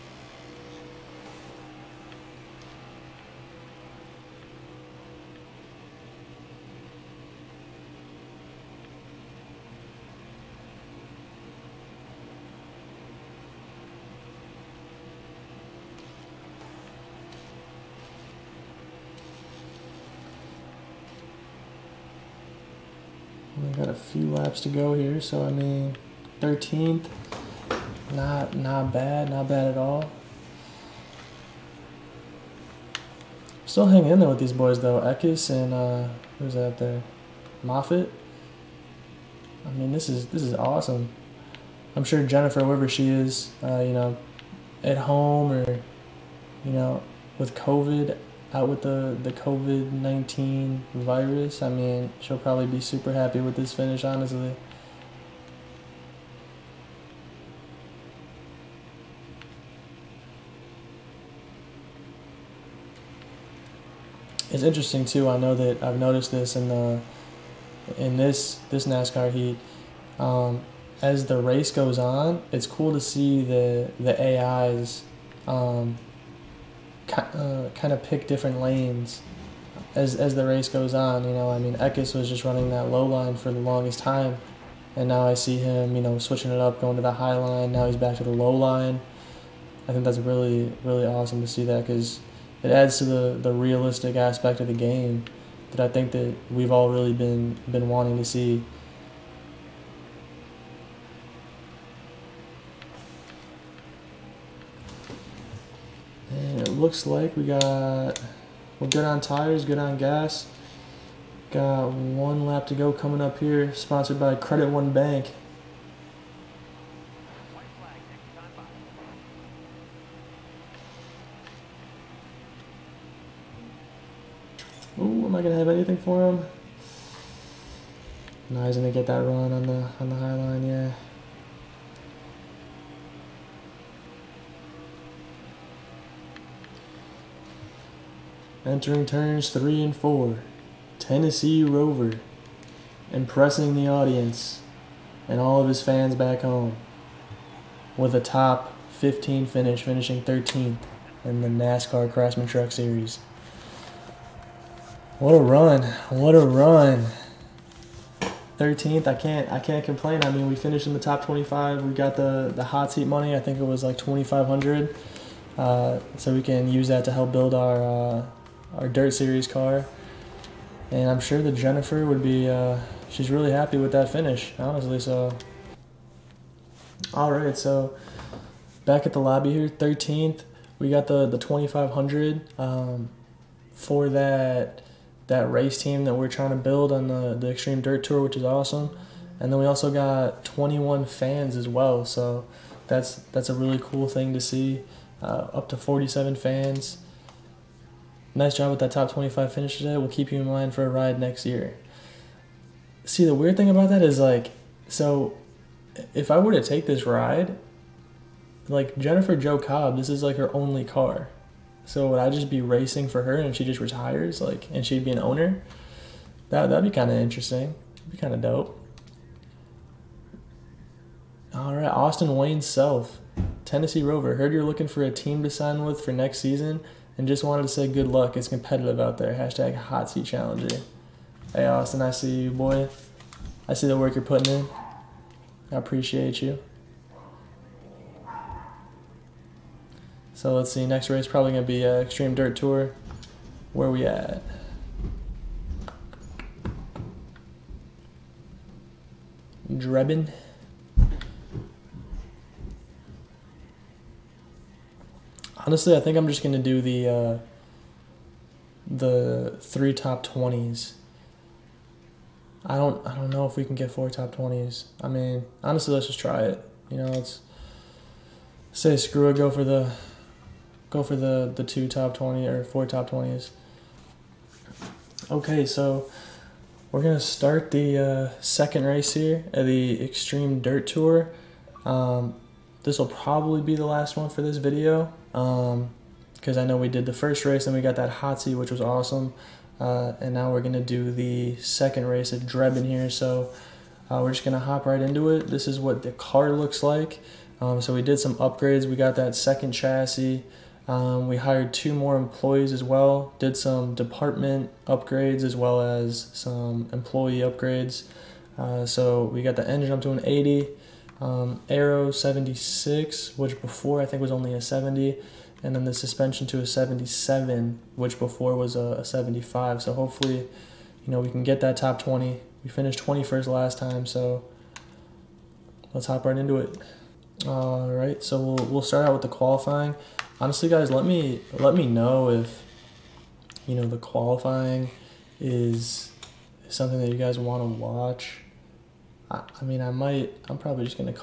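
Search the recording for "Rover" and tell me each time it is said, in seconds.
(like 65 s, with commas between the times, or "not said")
141 s, 224 s.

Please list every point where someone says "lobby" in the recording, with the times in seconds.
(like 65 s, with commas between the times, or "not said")
179 s.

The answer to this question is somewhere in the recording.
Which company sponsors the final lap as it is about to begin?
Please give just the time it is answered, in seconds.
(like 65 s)
114 s.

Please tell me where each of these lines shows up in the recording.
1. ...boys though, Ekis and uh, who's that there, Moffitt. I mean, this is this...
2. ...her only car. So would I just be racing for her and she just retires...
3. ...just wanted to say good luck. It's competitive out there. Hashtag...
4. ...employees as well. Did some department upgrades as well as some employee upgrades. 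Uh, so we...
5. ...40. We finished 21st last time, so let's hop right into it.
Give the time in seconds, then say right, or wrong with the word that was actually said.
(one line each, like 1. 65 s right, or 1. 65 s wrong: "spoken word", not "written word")
1. 34 s right
2. 210 s right
3. 227 s right
4. 302 s right
5. 322 s wrong: "20", not "40".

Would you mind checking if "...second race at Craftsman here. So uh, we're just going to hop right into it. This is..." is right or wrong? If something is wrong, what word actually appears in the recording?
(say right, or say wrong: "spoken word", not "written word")
wrong: "Drebin", not "Craftsman".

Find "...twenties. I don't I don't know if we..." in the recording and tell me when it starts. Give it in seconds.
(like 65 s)
260 s.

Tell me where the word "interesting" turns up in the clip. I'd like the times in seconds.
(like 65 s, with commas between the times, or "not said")
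64 s, 217 s.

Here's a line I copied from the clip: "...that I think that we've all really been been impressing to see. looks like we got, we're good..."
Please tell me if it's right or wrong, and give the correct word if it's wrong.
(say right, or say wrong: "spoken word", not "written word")
wrong: "wanting", not "impressing".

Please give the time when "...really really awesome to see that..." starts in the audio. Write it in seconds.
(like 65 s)
90 s.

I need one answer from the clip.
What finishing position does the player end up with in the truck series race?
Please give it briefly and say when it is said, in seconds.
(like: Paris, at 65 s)
13th, at 149 s.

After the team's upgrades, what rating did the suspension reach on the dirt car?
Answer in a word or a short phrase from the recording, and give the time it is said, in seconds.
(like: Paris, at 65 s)
77, at 316 s.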